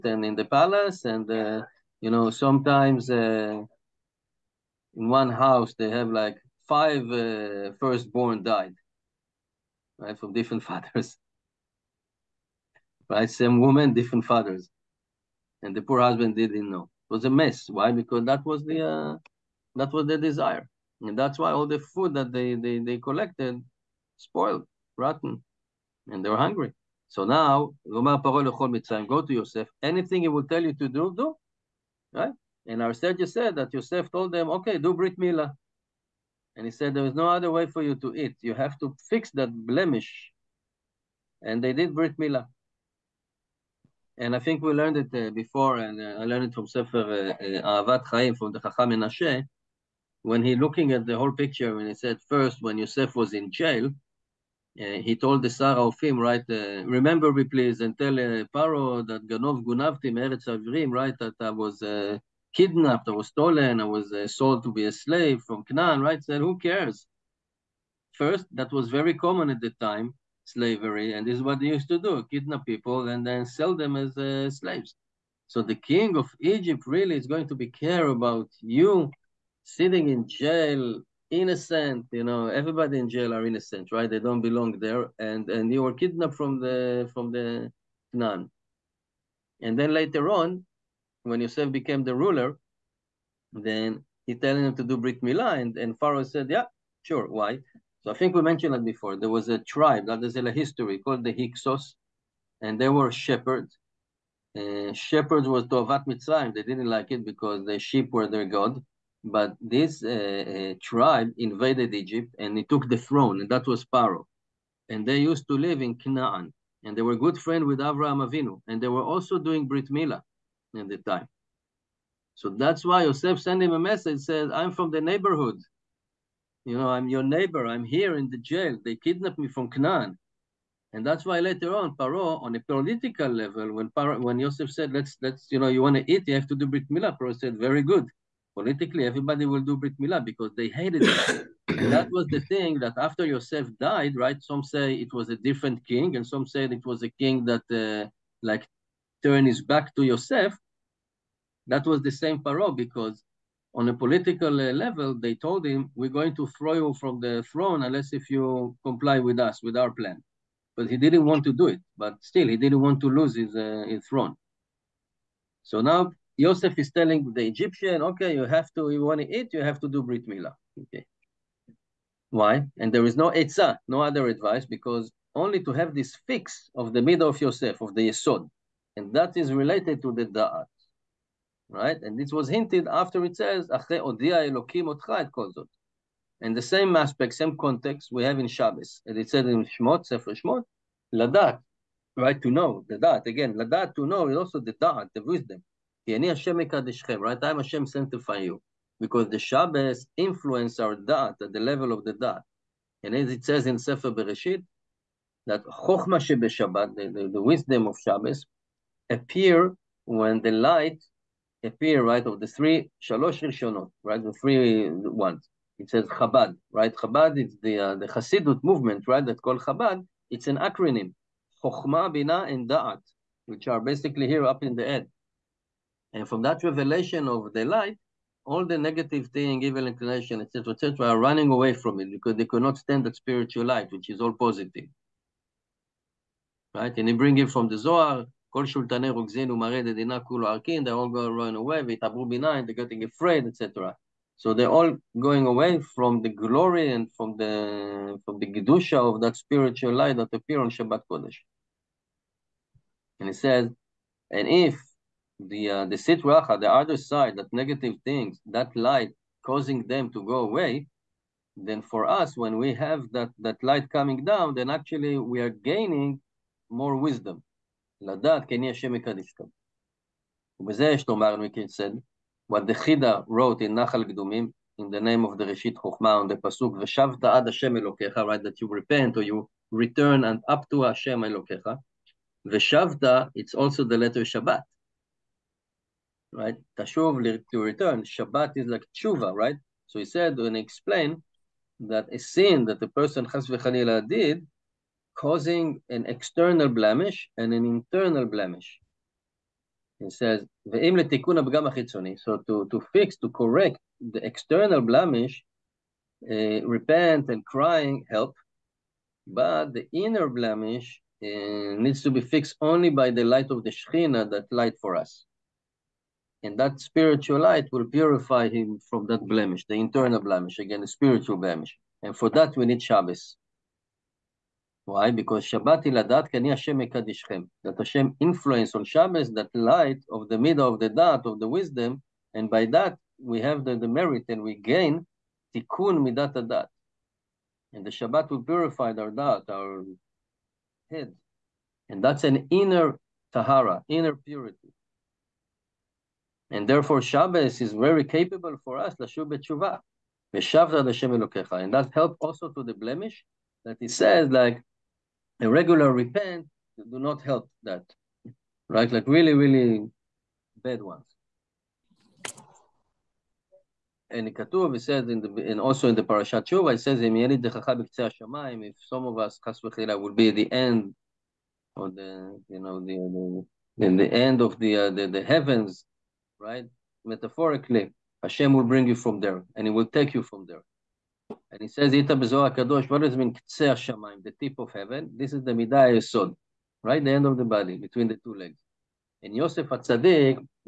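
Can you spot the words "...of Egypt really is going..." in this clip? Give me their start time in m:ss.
1:16.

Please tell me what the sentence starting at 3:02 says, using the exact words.
And this was hinted after it says, And the same aspect, same context we have in Shabbos.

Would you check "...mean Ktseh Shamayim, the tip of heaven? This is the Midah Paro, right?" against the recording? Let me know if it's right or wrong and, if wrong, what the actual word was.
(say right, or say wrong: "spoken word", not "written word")
wrong: "Yesod", not "Paro".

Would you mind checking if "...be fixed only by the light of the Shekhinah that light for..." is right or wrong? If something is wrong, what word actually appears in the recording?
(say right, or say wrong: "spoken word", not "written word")
right.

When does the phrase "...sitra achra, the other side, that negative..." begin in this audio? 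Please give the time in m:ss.
4:16.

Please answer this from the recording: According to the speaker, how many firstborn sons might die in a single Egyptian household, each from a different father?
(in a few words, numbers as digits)
5.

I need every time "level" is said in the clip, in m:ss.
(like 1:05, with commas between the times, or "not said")
2:13, 2:34, 3:21.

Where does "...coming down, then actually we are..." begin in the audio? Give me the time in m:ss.
4:23.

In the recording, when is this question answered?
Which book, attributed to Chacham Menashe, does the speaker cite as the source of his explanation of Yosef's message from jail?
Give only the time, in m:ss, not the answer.
0:47.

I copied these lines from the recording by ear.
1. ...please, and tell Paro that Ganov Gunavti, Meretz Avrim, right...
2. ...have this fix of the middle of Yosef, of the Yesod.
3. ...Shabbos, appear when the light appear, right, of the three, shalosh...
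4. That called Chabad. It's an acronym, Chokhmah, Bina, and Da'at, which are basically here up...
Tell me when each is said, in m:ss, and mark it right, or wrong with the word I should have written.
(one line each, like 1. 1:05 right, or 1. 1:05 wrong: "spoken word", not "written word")
1. 0:57 right
2. 2:55 right
3. 3:28 right
4. 3:39 right.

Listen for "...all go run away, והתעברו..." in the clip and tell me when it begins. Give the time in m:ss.
4:00.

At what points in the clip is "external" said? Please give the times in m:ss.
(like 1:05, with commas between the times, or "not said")
4:56, 5:04.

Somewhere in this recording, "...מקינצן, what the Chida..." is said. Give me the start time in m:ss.
4:31.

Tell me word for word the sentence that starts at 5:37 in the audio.
And the Shabbat will purify our dat, our head, and that's an inner tahara, inner purity.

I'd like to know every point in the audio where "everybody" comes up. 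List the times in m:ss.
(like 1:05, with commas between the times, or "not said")
1:22, 2:19.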